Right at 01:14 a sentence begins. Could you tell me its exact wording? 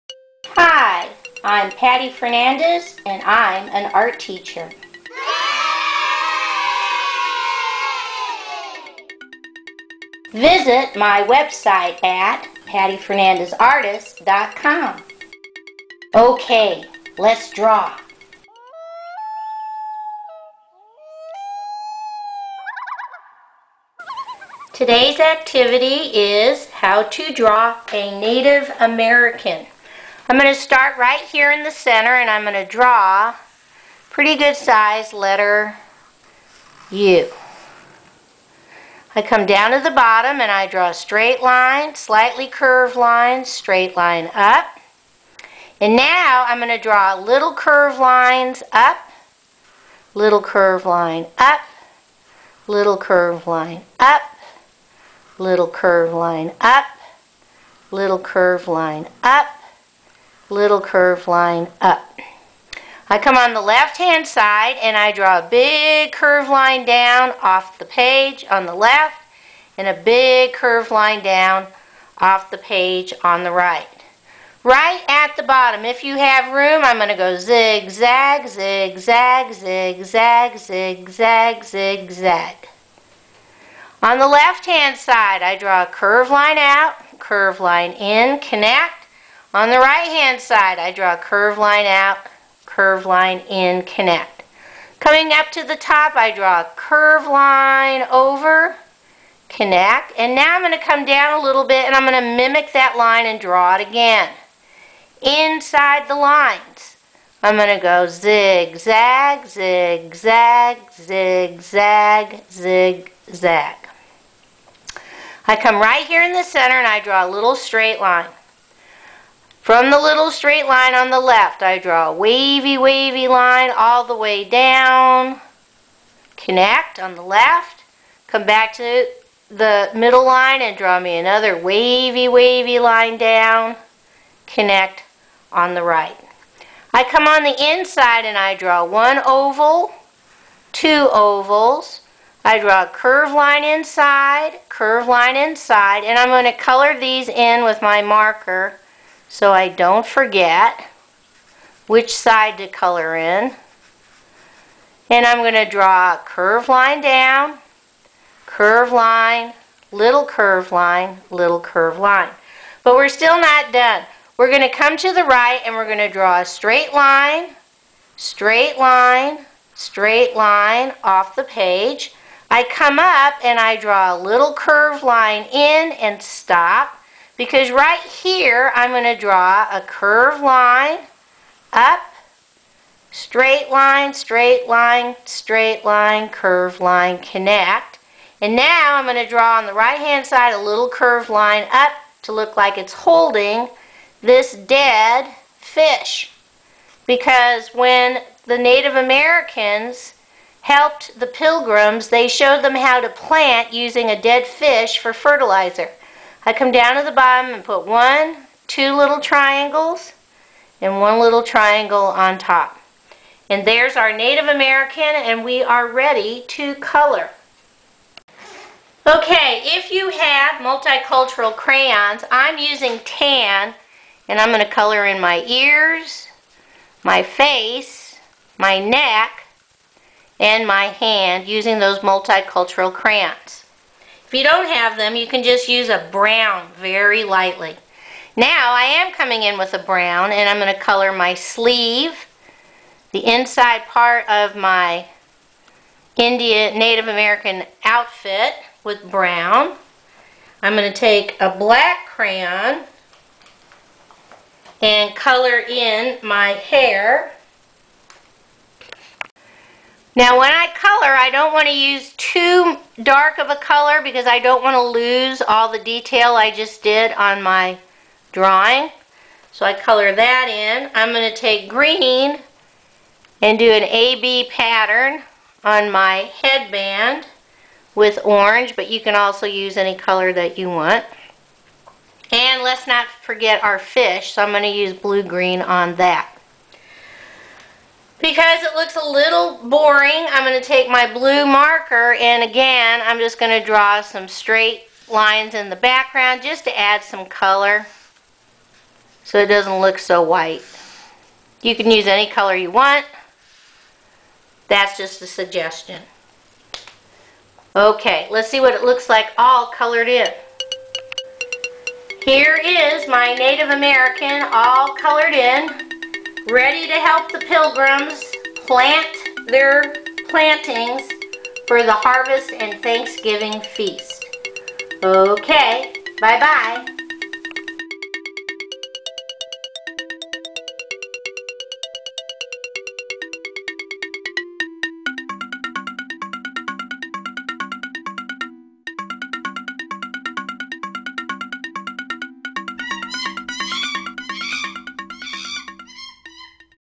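Right at the bottom, if you have room, I'm going to go zigzag, zigzag, zigzag, zigzag, zigzag.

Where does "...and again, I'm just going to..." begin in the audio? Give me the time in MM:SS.
04:52.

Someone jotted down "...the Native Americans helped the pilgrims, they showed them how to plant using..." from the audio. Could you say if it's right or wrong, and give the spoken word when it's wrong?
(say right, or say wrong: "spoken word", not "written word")
right.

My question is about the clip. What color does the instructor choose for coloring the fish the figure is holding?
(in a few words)
Blue-green.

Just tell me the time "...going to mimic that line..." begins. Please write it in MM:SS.
01:42.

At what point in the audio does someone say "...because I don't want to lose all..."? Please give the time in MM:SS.
04:24.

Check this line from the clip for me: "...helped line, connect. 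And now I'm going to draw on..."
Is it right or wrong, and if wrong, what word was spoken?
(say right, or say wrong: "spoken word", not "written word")
wrong: "curved", not "helped".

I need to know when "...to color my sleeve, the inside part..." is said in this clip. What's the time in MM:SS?
04:00.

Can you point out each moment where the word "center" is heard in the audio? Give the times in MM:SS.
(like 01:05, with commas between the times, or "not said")
00:31, 01:56.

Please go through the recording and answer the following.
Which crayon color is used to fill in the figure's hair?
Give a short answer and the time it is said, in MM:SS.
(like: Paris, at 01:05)
Black, at 04:11.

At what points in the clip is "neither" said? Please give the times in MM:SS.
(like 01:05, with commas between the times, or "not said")
not said.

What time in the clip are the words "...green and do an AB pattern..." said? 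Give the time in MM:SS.
04:31.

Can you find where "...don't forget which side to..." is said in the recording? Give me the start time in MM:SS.
02:29.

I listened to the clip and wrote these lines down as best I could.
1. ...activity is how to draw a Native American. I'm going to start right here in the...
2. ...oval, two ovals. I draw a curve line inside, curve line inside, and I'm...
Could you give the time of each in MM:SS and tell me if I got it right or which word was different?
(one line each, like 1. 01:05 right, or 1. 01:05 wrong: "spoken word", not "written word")
1. 00:25 right
2. 02:19 right.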